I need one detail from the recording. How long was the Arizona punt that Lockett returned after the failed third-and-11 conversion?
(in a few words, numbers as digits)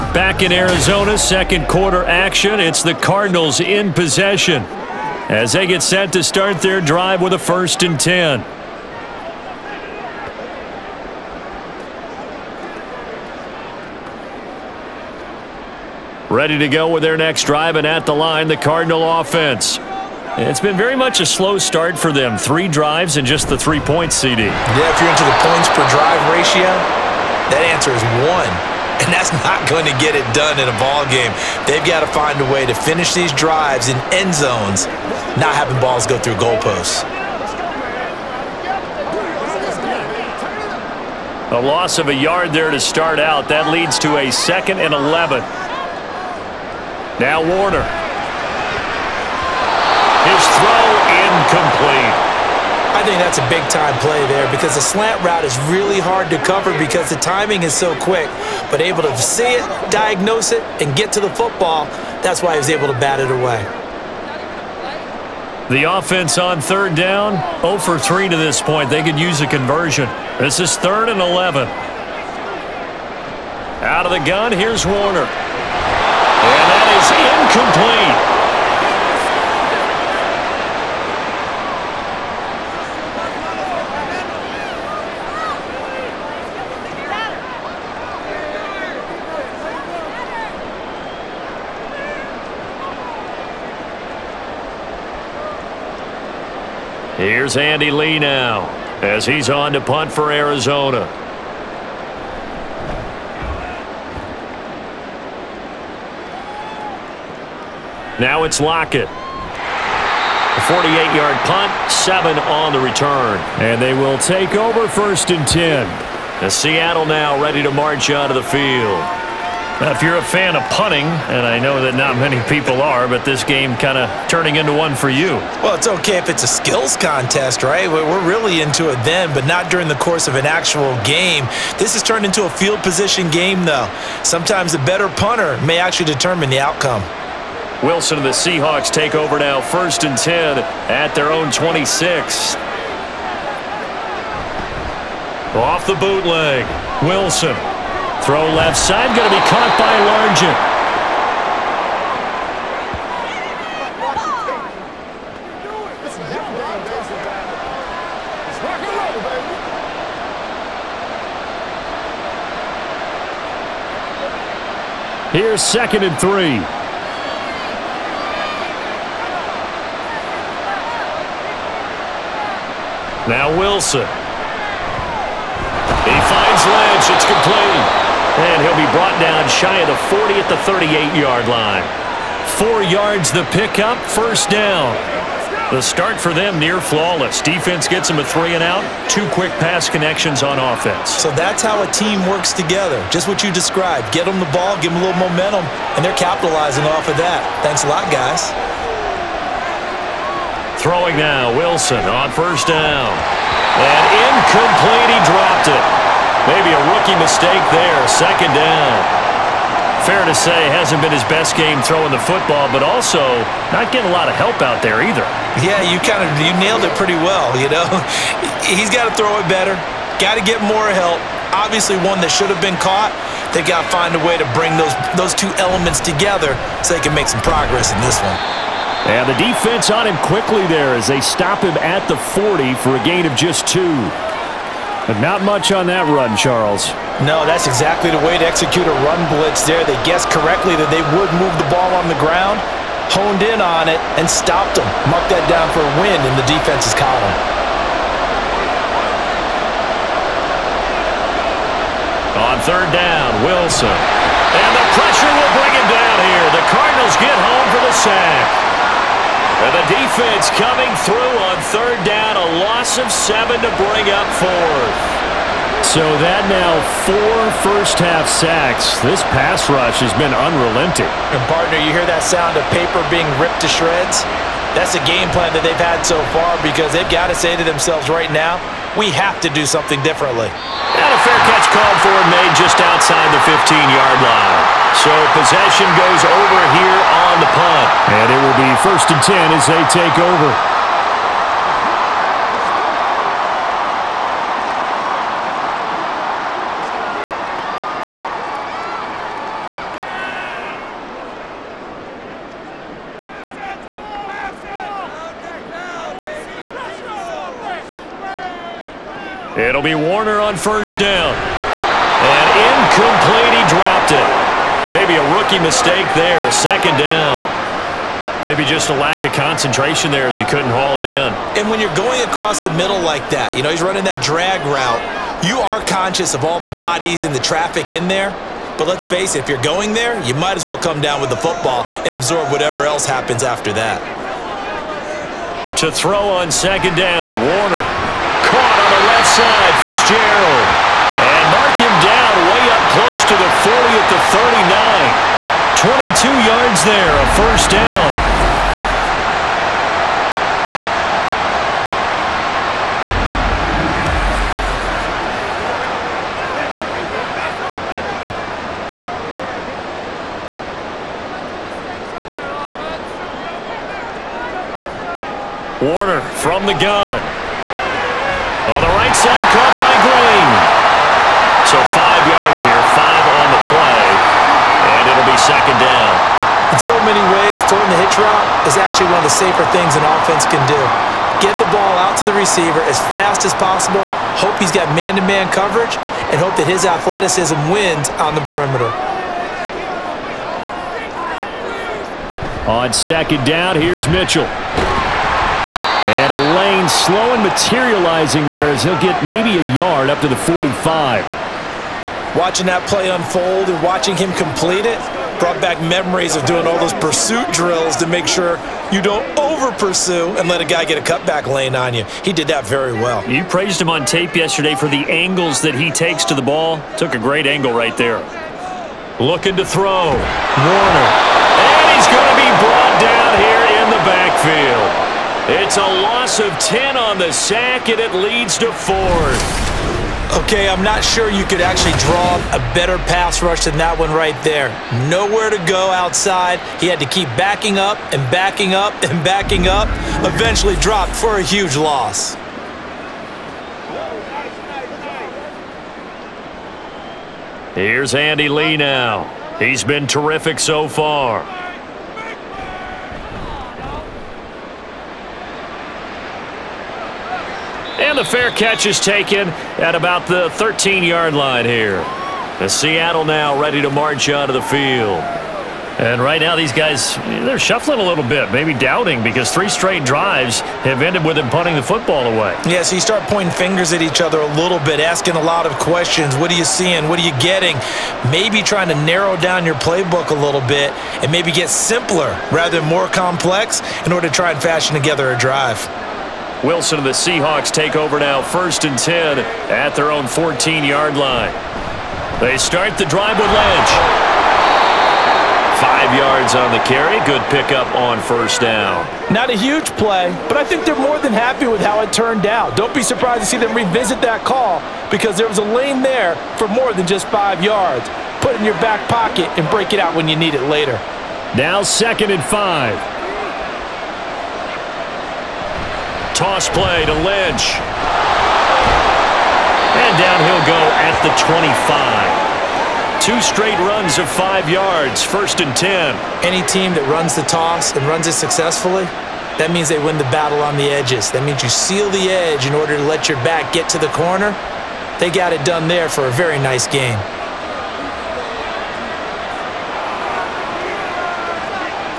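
48 yards.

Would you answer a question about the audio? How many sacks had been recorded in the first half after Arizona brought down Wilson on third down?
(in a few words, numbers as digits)
4.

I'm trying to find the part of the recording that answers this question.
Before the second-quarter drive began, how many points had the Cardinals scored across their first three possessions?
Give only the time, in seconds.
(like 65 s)
23 s.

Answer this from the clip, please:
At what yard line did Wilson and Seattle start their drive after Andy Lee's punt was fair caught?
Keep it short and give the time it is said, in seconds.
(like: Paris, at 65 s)
14, at 490 s.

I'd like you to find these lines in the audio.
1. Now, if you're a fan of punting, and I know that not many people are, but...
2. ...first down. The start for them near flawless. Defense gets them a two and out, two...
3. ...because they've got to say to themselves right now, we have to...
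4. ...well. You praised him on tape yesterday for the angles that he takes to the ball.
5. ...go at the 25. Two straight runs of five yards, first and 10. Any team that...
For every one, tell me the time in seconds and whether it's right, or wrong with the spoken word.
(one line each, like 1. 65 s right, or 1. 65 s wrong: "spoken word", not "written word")
1. 119 s right
2. 184 s wrong: "three", not "two"
3. 276 s right
4. 412 s right
5. 520 s right.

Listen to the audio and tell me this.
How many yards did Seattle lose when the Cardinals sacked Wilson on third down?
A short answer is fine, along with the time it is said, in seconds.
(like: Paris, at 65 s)
7, at 262 s.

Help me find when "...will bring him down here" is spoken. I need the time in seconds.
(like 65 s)
255 s.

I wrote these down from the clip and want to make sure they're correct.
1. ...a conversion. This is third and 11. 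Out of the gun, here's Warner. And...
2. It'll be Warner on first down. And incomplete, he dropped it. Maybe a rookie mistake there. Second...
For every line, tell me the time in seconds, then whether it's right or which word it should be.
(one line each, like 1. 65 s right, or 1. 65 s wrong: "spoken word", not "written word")
1. 69 s right
2. 309 s right.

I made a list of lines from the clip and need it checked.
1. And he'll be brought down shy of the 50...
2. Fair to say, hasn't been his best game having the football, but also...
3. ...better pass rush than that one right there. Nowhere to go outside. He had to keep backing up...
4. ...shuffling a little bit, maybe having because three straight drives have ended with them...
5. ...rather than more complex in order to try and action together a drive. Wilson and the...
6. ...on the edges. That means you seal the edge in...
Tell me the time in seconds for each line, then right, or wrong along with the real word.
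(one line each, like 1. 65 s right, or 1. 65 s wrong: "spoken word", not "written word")
1. 178 s wrong: "40", not "50"
2. 210 s wrong: "throwing", not "having"
3. 432 s right
4. 467 s wrong: "doubting", not "having"
5. 482 s wrong: "fashion", not "action"
6. 530 s right.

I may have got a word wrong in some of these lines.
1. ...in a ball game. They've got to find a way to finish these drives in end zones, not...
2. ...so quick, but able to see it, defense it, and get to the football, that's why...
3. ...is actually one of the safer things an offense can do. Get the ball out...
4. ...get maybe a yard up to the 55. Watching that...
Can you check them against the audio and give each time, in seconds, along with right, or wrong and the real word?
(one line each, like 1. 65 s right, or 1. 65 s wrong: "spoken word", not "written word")
1. 30 s right
2. 57 s wrong: "diagnose", not "defense"
3. 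378 s right
4. 399 s wrong: "45", not "55".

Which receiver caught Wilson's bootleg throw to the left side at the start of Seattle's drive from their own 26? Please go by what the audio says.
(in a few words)
Largent.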